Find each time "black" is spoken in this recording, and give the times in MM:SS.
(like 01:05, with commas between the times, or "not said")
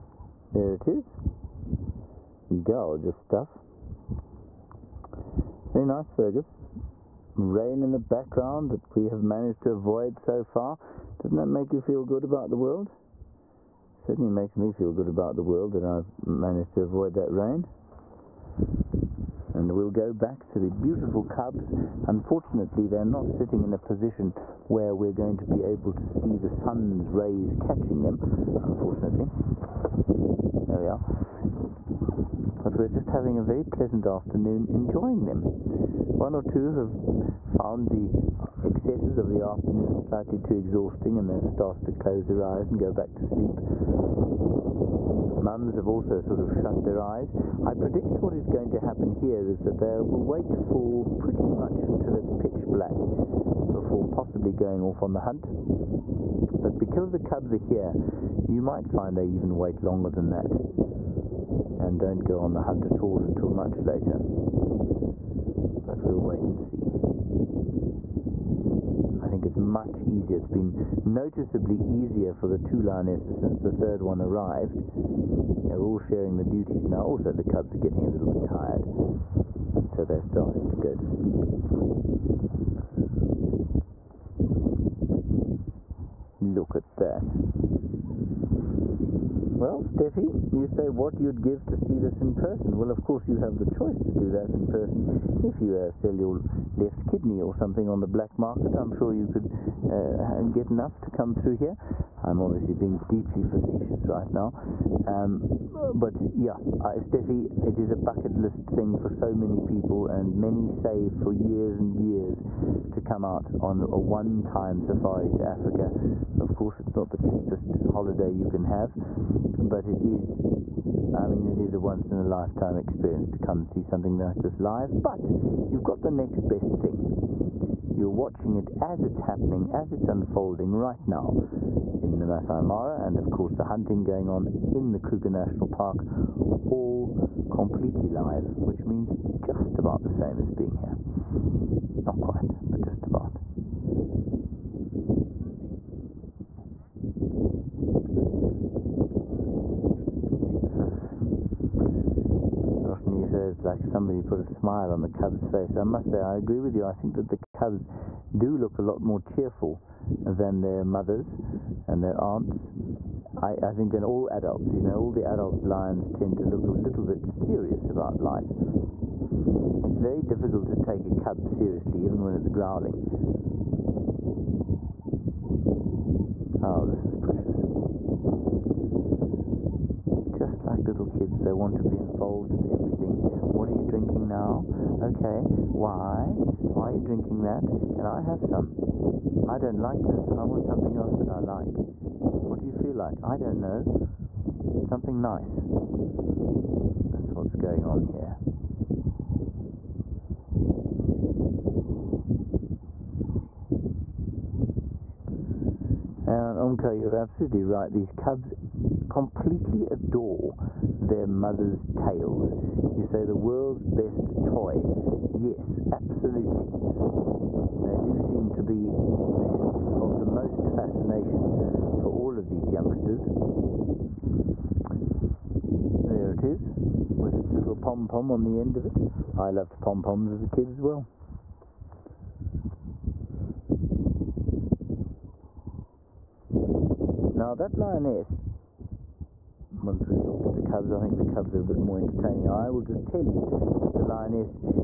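00:52, 01:38.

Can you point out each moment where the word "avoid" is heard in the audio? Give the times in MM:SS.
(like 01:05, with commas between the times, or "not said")
00:09, 00:16.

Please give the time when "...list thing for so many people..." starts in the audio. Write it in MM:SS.
01:48.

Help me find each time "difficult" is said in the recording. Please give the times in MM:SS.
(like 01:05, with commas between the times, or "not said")
02:50.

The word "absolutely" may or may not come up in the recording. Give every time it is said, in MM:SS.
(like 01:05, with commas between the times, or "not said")
03:27, 03:35.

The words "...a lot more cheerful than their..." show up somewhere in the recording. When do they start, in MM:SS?
02:38.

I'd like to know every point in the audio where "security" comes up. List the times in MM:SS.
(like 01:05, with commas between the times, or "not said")
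not said.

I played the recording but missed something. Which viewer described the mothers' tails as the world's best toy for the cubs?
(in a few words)
Umko.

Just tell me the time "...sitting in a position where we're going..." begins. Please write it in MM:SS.
00:23.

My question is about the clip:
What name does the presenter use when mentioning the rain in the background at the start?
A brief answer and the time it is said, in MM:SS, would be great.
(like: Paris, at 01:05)
Fergus, at 00:06.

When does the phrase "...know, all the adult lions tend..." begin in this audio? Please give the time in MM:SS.
02:44.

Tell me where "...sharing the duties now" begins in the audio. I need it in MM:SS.
01:15.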